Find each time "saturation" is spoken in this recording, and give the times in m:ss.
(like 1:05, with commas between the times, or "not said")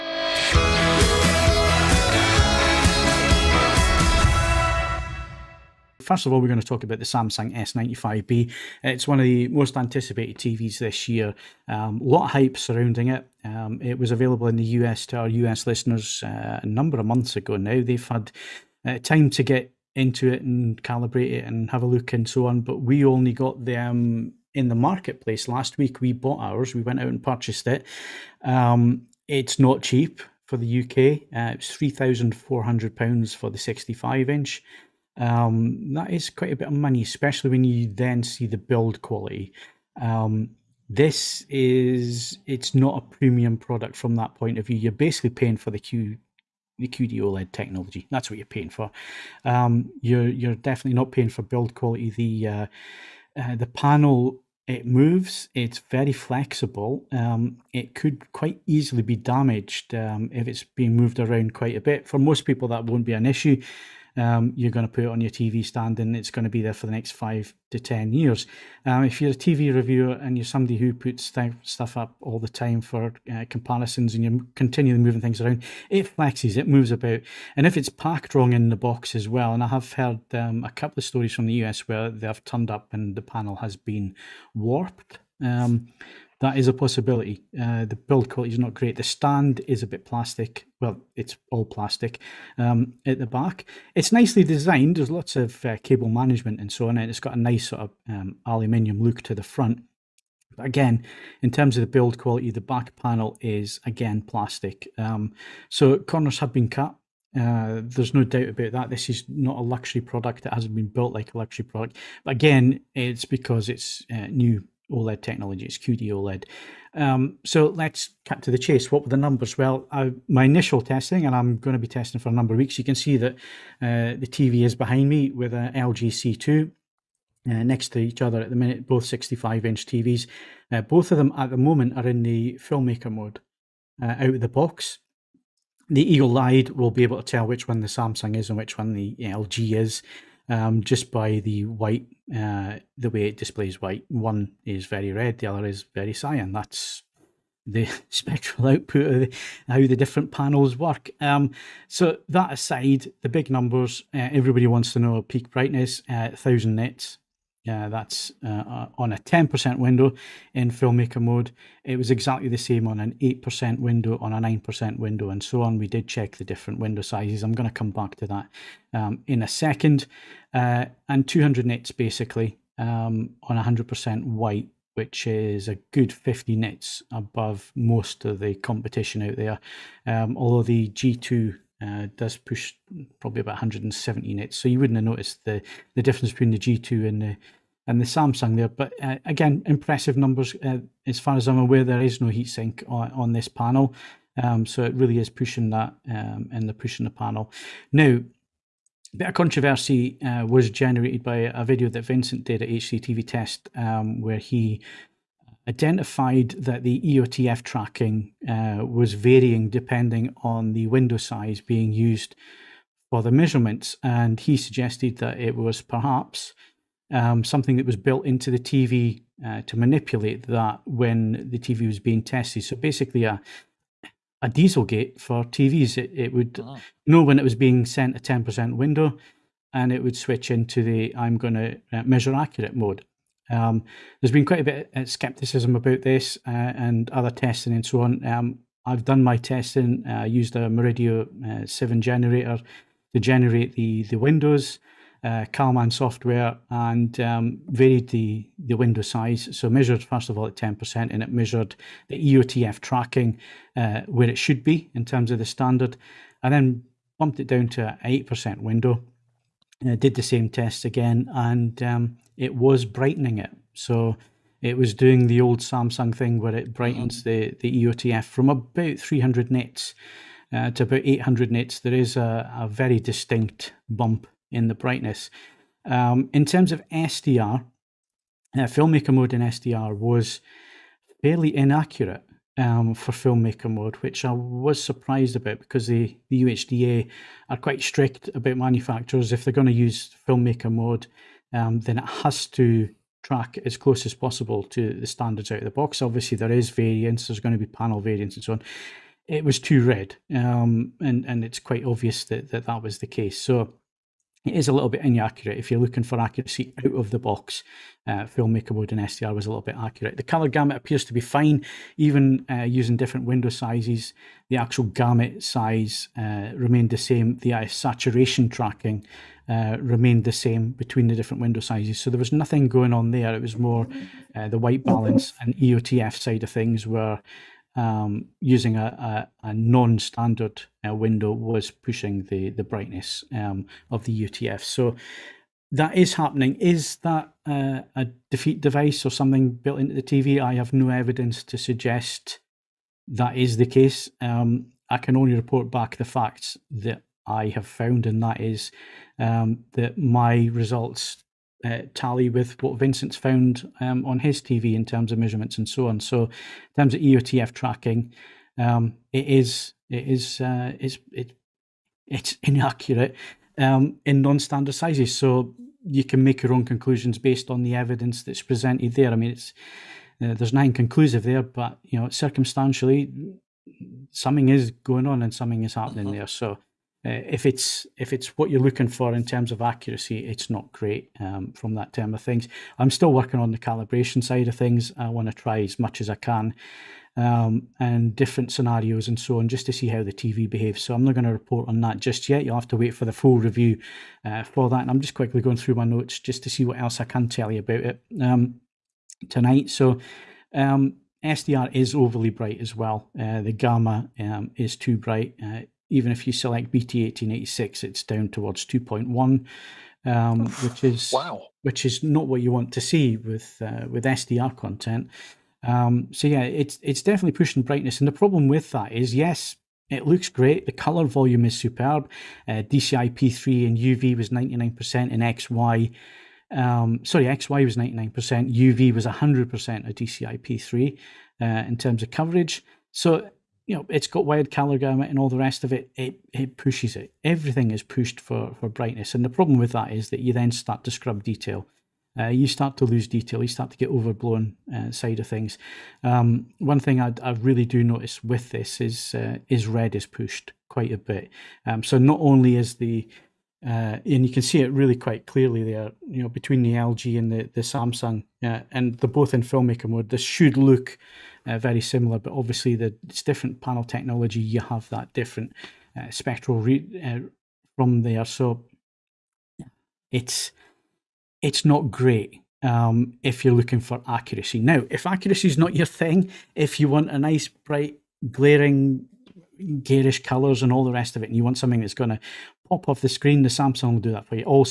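5:17.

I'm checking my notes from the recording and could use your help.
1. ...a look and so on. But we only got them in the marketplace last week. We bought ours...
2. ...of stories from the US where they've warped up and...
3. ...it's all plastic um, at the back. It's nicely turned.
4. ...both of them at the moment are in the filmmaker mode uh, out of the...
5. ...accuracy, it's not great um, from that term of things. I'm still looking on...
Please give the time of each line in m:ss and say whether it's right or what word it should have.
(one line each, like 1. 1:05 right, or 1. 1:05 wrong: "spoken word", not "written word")
1. 0:21 right
2. 1:21 wrong: "turned", not "warped"
3. 1:31 wrong: "designed", not "turned"
4. 2:10 right
5. 6:19 wrong: "working", not "looking".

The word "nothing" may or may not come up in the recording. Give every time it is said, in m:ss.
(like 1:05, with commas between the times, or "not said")
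5:22, 6:10.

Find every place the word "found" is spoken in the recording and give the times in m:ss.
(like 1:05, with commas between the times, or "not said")
5:47, 5:53.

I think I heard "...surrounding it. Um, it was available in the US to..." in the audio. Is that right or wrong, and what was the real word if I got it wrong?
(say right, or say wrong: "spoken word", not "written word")
right.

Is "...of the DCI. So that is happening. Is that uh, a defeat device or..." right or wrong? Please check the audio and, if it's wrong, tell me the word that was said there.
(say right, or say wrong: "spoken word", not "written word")
wrong: "EOTF", not "DCI".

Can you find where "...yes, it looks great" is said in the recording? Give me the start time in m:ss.
6:59.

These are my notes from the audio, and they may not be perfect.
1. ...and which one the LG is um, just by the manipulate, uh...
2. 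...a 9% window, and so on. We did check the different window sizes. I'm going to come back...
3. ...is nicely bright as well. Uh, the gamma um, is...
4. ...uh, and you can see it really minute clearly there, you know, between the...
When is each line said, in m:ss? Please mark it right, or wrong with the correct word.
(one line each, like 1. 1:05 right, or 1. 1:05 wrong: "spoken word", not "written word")
1. 2:18 wrong: "white", not "manipulate"
2. 2:44 right
3. 6:41 wrong: "overly", not "nicely"
4. 7:33 wrong: "quite", not "minute".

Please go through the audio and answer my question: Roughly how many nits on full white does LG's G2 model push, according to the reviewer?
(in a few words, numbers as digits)
170 nits.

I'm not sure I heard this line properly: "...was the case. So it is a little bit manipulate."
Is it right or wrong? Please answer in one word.
wrong.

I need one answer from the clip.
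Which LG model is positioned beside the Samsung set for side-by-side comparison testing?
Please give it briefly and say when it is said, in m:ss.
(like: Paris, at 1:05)
LG C2, at 2:05.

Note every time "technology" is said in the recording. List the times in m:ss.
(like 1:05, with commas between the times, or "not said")
0:47, 1:55, 7:43.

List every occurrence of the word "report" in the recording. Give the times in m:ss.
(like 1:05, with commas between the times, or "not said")
5:45, 6:31.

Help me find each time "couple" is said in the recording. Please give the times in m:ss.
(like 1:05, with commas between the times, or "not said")
1:20.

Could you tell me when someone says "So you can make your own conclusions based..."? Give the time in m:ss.
6:05.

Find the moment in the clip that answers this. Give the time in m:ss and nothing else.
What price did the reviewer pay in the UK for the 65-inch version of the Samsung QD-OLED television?
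0:31.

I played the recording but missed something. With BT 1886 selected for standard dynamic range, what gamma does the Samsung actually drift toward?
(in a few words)
2.1.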